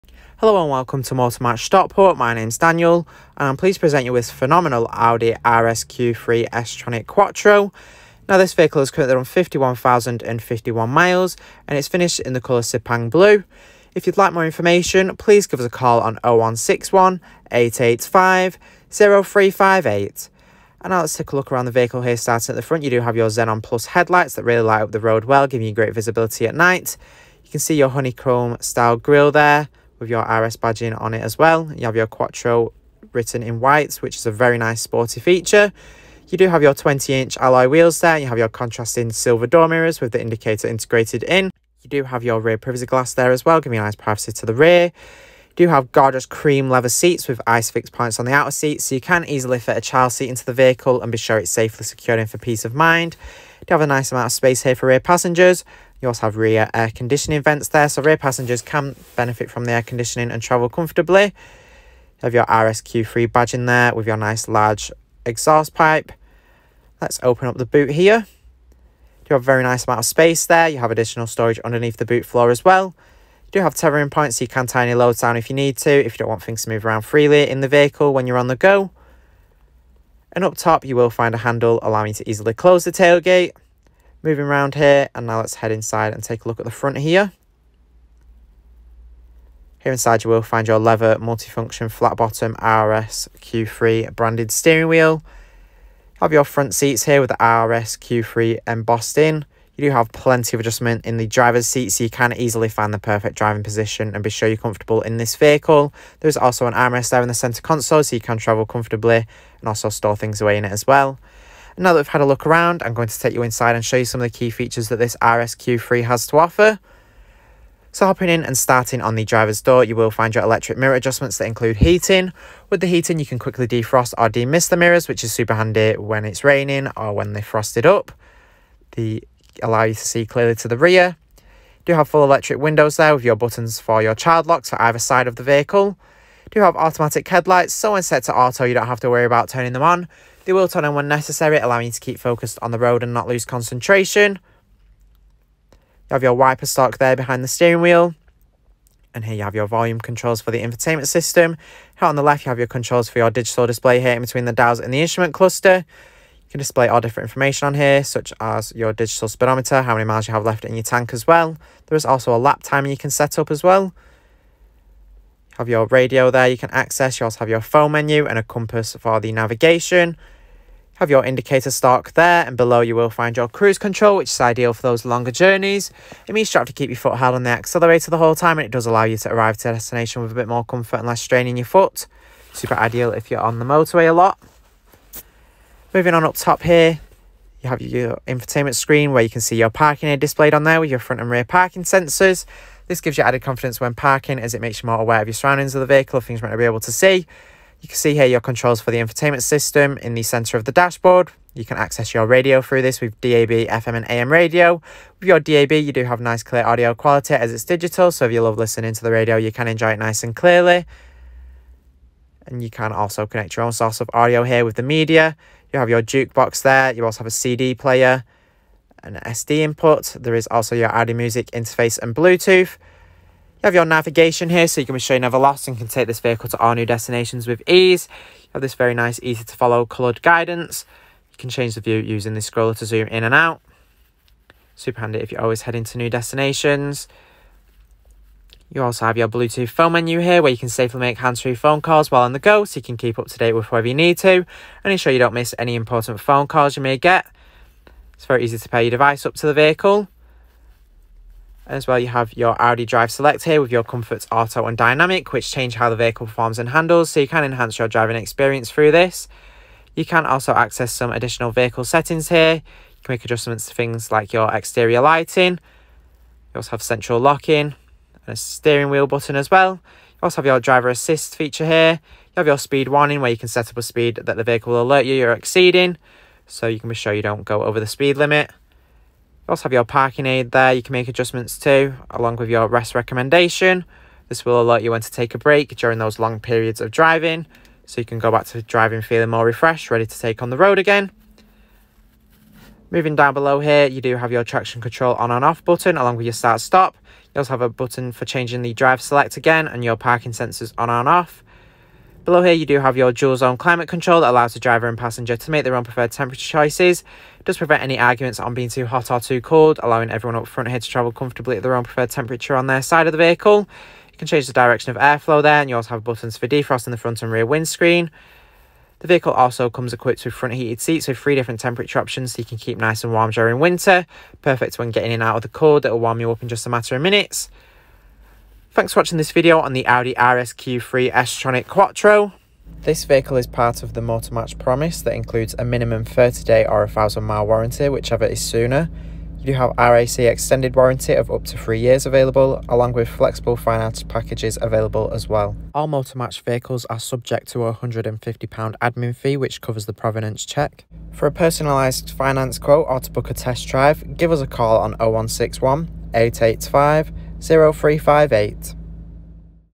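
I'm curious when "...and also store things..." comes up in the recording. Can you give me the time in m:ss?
1:49.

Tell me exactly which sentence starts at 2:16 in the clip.
do have automatic headlights, so when set to auto, you don't have to worry about turning them on.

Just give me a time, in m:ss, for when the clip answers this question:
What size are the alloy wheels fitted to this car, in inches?
0:36.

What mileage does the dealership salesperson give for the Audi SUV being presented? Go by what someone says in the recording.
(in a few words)
51,051 miles.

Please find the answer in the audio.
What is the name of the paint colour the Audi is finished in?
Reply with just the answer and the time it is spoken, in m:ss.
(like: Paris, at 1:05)
Sepang Blue, at 0:12.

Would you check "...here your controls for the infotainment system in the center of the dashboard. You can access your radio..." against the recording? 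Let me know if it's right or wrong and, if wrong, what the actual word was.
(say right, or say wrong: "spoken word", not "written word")
right.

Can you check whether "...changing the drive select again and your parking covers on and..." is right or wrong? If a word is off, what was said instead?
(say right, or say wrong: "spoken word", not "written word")
wrong: "sensors", not "covers".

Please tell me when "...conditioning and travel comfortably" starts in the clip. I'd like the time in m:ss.
0:59.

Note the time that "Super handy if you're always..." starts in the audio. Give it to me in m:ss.
3:54.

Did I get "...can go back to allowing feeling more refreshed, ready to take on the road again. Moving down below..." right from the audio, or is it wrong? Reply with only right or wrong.
wrong.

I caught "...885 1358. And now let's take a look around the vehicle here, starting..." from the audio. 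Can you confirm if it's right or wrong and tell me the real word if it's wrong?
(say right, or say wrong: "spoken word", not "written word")
wrong: "0358", not "1358".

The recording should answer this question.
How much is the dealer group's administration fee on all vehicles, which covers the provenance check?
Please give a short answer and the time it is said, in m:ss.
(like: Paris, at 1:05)
£150, at 5:47.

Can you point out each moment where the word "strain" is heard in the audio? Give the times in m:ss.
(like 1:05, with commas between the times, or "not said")
3:01.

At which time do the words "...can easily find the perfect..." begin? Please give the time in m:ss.
1:42.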